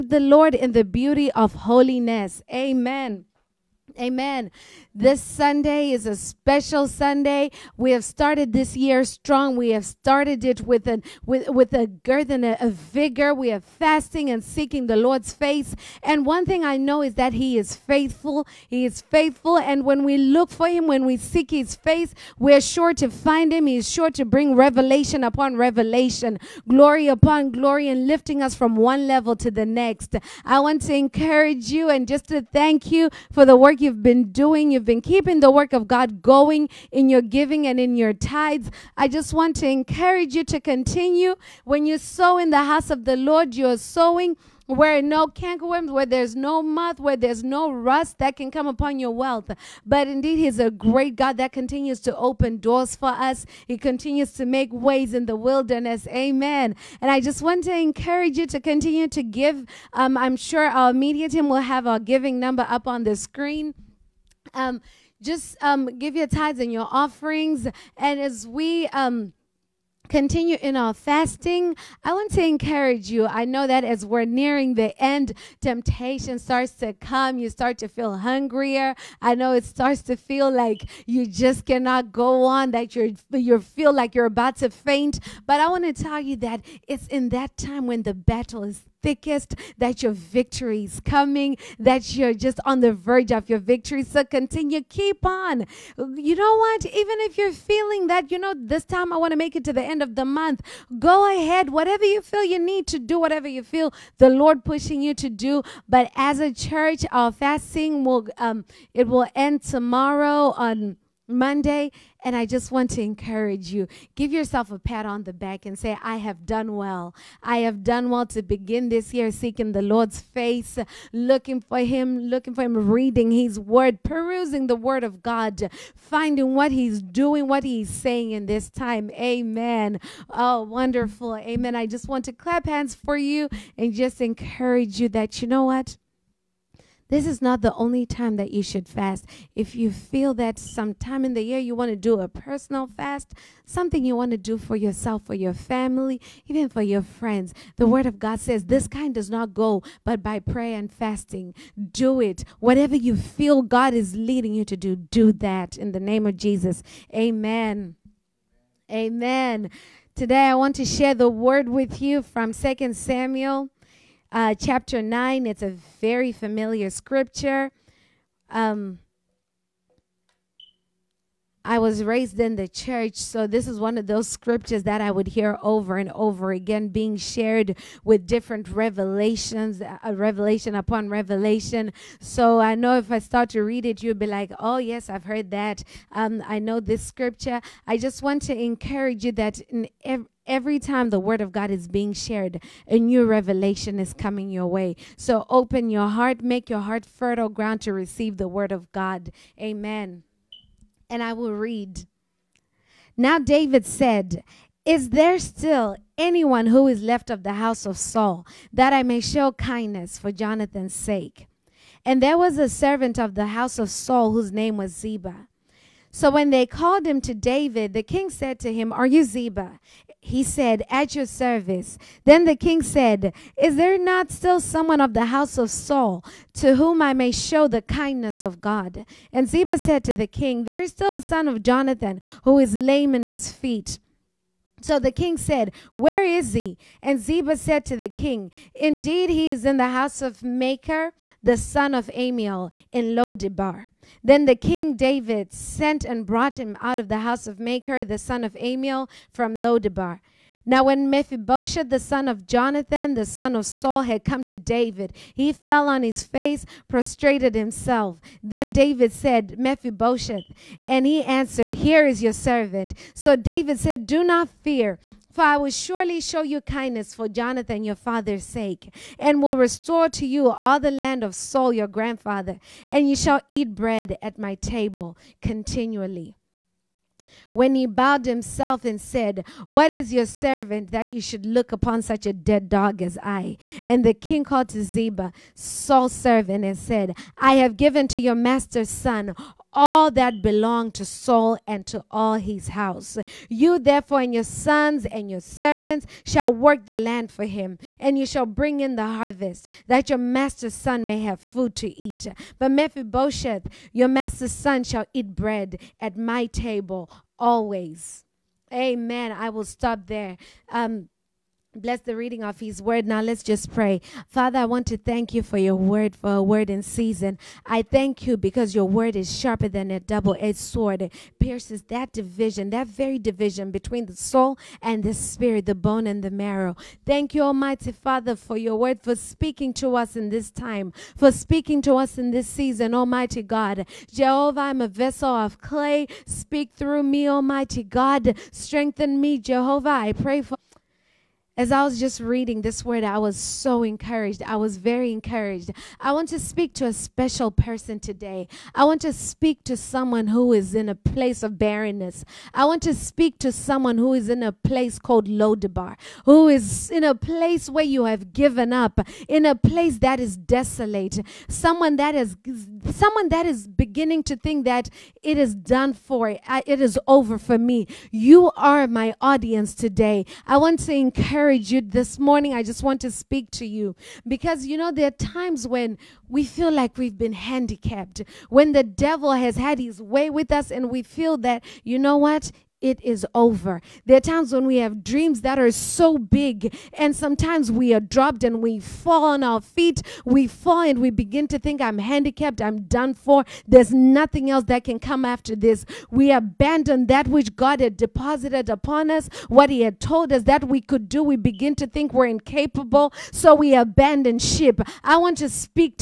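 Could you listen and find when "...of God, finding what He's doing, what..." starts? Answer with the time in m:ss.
2:05.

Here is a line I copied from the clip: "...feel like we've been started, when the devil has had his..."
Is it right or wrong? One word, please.
wrong.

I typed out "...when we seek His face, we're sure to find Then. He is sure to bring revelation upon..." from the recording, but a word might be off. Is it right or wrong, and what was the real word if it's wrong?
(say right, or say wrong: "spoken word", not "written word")
wrong: "Him", not "Then".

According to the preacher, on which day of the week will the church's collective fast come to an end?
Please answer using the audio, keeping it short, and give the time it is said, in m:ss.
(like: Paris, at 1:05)
Monday, at 1:51.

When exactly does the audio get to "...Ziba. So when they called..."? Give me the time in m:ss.
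3:34.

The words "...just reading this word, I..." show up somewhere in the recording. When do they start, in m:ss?
5:41.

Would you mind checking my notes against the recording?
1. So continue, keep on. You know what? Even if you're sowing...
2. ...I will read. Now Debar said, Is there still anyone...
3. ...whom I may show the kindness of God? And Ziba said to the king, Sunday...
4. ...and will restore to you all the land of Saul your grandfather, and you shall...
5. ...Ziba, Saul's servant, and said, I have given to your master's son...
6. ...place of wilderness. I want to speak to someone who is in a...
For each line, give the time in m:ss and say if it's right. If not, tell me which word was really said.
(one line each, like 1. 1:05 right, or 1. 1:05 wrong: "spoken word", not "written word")
1. 1:34 wrong: "feeling", not "sowing"
2. 3:21 wrong: "David", not "Debar"
3. 3:46 wrong: "There", not "Sunday"
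4. 4:29 right
5. 4:44 right
6. 5:50 wrong: "barrenness", not "wilderness".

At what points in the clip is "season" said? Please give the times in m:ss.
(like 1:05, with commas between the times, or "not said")
5:16, 5:32.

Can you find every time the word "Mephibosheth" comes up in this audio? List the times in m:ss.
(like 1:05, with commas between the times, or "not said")
4:11, 4:19, 5:02.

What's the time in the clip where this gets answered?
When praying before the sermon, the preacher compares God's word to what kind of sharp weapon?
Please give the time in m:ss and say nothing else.
5:19.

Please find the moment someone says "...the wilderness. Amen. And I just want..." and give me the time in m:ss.
0:55.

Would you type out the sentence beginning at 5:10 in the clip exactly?
Um, Bless the reading of his word.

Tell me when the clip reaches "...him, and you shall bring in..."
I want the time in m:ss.
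4:57.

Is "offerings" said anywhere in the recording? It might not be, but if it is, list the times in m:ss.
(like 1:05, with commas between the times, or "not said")
1:06.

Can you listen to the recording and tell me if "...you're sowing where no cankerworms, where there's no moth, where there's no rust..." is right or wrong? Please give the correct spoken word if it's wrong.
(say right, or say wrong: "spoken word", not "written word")
right.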